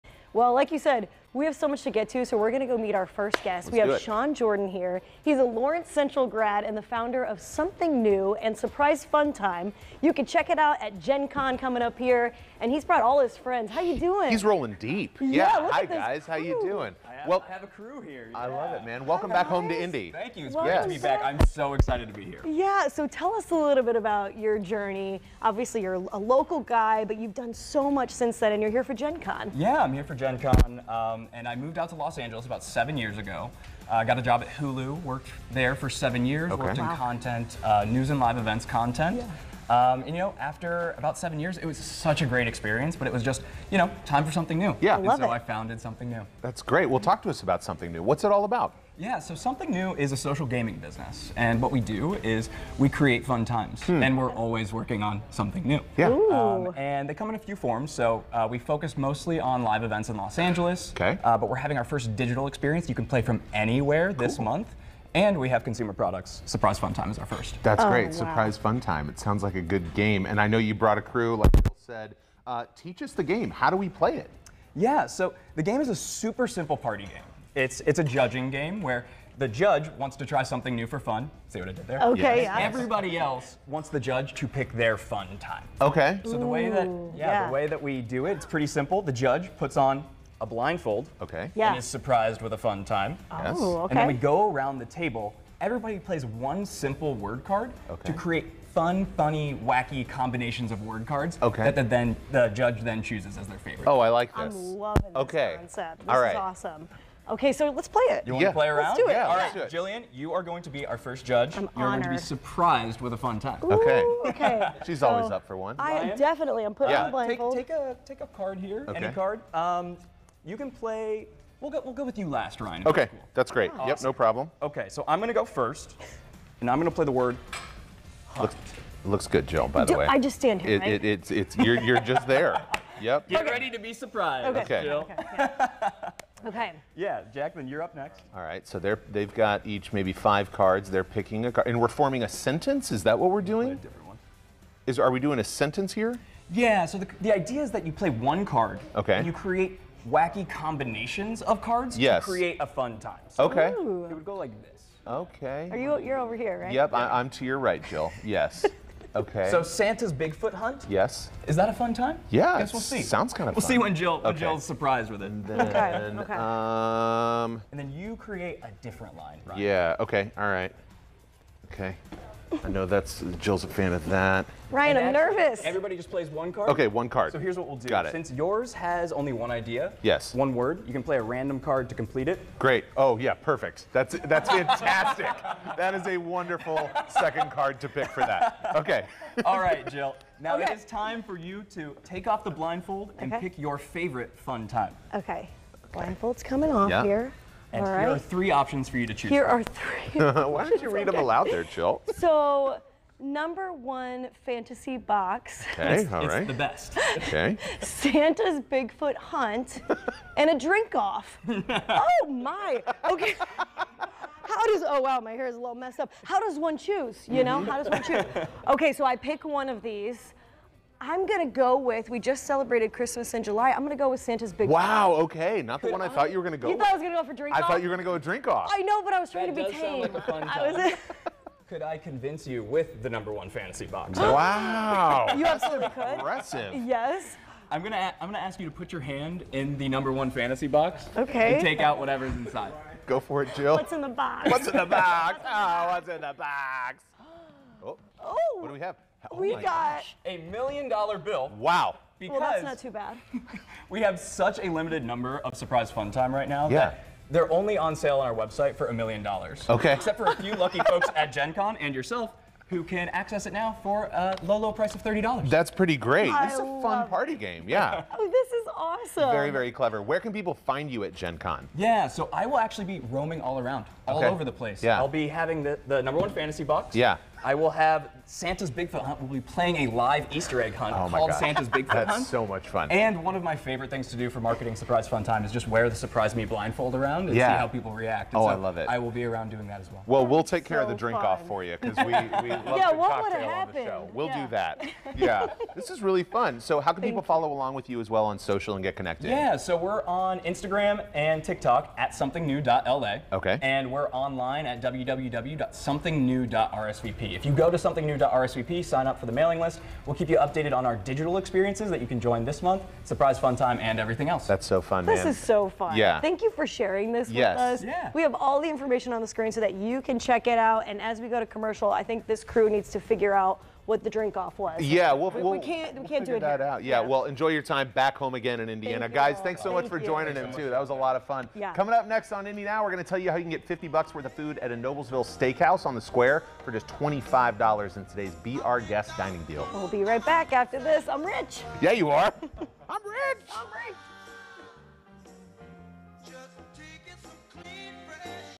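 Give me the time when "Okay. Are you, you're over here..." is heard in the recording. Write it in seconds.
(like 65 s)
155 s.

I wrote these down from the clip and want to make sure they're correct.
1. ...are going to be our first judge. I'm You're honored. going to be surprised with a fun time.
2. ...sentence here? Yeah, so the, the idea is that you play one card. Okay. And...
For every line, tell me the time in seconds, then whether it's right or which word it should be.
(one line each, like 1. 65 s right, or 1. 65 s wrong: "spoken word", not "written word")
1. 110 s right
2. 145 s right.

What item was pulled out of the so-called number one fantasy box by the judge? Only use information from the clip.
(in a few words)
a million dollar bill.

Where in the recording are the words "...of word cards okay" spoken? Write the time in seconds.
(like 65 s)
100 s.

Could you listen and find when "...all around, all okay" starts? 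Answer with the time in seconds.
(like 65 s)
273 s.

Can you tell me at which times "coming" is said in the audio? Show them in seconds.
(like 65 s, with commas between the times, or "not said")
11 s, 196 s, 331 s.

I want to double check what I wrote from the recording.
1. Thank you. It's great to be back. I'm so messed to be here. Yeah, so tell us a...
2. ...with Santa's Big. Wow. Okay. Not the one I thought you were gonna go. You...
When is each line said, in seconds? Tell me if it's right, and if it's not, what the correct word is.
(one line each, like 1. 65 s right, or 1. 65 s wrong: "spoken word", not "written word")
1. 20 s wrong: "excited", not "messed"
2. 224 s right.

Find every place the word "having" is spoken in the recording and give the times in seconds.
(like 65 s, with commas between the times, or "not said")
61 s, 275 s.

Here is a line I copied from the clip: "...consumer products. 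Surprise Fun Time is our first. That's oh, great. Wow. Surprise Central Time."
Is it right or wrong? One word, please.
wrong.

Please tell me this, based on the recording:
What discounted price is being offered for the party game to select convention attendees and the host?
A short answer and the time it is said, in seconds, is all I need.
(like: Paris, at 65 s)
$30, at 265 s.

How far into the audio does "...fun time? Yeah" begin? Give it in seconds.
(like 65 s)
161 s.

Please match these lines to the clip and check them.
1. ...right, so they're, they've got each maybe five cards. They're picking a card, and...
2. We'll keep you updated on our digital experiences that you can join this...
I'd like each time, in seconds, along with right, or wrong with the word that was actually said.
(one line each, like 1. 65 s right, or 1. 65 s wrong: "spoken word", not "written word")
1. 138 s right
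2. 310 s right.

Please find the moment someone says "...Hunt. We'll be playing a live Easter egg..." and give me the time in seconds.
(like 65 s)
279 s.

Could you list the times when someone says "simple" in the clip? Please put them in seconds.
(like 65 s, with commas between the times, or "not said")
76 s, 88 s, 96 s.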